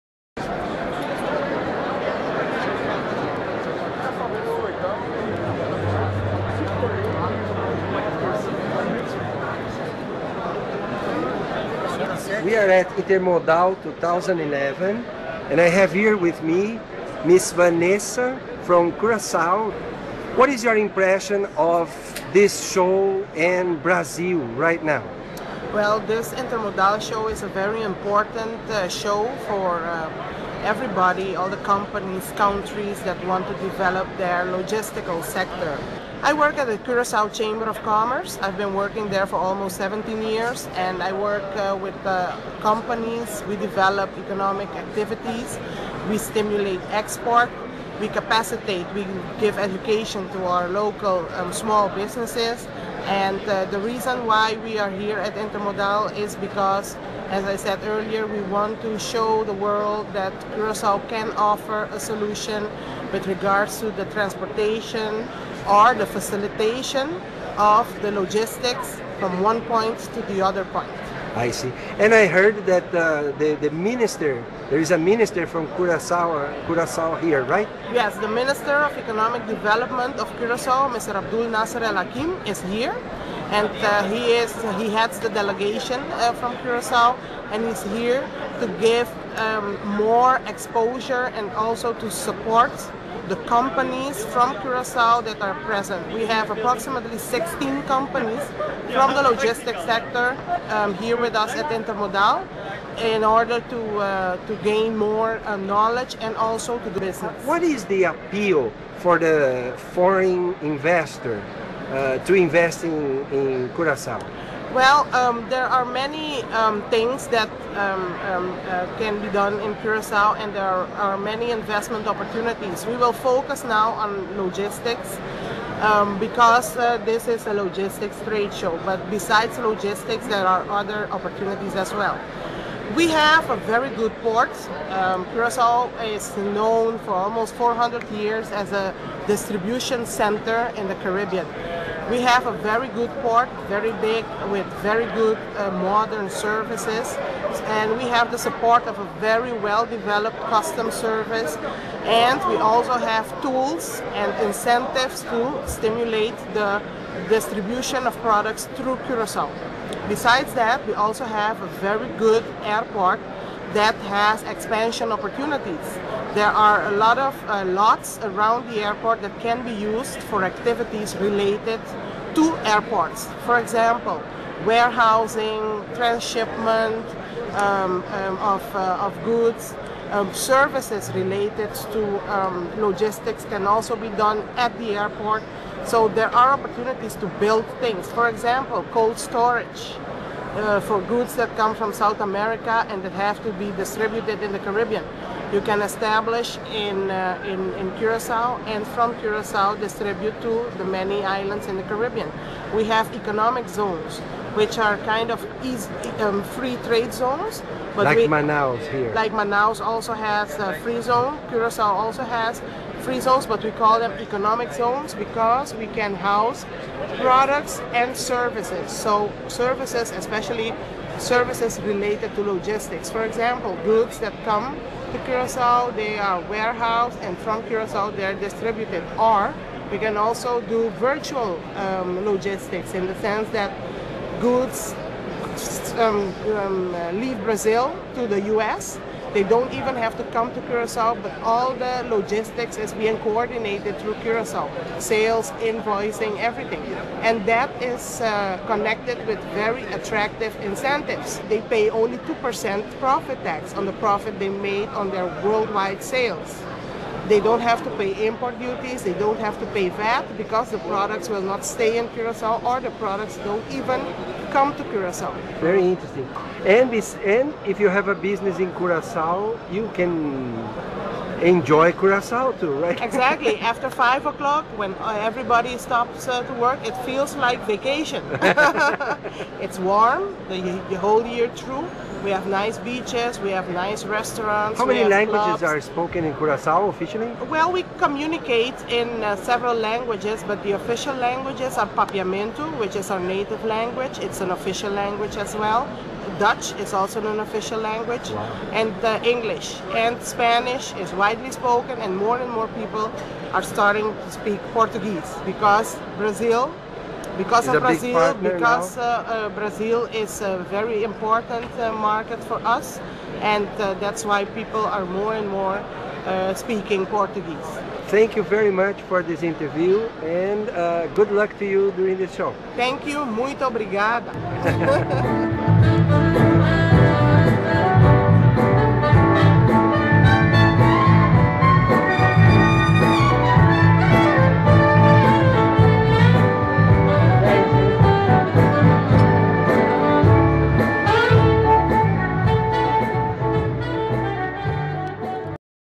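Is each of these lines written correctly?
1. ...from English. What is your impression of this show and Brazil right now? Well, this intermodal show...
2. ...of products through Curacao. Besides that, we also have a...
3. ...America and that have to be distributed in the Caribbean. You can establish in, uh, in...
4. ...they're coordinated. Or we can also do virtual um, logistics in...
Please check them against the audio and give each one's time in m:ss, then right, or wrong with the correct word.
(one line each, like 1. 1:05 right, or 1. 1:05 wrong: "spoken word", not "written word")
1. 0:18 wrong: "Curacao", not "English"
2. 2:38 right
3. 3:12 right
4. 3:48 wrong: "distributed", not "coordinated".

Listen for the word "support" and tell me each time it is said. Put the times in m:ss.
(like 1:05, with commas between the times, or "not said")
1:32, 2:28.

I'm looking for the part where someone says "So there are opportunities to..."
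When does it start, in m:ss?
3:05.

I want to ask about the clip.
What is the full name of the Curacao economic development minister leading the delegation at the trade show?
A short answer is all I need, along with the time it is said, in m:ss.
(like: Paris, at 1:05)
Abdul Nasser El Hakim, at 1:21.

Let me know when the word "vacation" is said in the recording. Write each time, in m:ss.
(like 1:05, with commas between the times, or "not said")
4:37.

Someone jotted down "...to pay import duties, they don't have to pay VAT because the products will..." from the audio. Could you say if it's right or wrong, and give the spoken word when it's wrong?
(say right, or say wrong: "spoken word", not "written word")
right.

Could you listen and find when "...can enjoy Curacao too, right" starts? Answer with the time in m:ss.
4:29.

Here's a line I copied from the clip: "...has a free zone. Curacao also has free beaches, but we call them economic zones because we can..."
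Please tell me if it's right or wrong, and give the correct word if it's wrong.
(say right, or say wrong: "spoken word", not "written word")
wrong: "zones", not "beaches".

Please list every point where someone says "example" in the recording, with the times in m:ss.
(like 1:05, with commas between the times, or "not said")
2:53, 3:08, 3:43.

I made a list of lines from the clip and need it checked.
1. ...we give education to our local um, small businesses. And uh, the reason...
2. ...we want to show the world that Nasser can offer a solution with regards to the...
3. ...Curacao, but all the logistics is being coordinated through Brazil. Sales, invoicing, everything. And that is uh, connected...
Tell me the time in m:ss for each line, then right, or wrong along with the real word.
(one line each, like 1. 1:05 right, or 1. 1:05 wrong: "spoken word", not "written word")
1. 0:48 right
2. 0:58 wrong: "Curacao", not "Nasser"
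3. 4:00 wrong: "Curacao", not "Brazil".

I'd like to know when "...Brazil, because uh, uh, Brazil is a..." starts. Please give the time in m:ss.
5:07.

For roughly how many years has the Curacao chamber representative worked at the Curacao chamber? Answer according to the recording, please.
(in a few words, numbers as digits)
17 years.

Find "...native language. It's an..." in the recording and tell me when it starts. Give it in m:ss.
4:53.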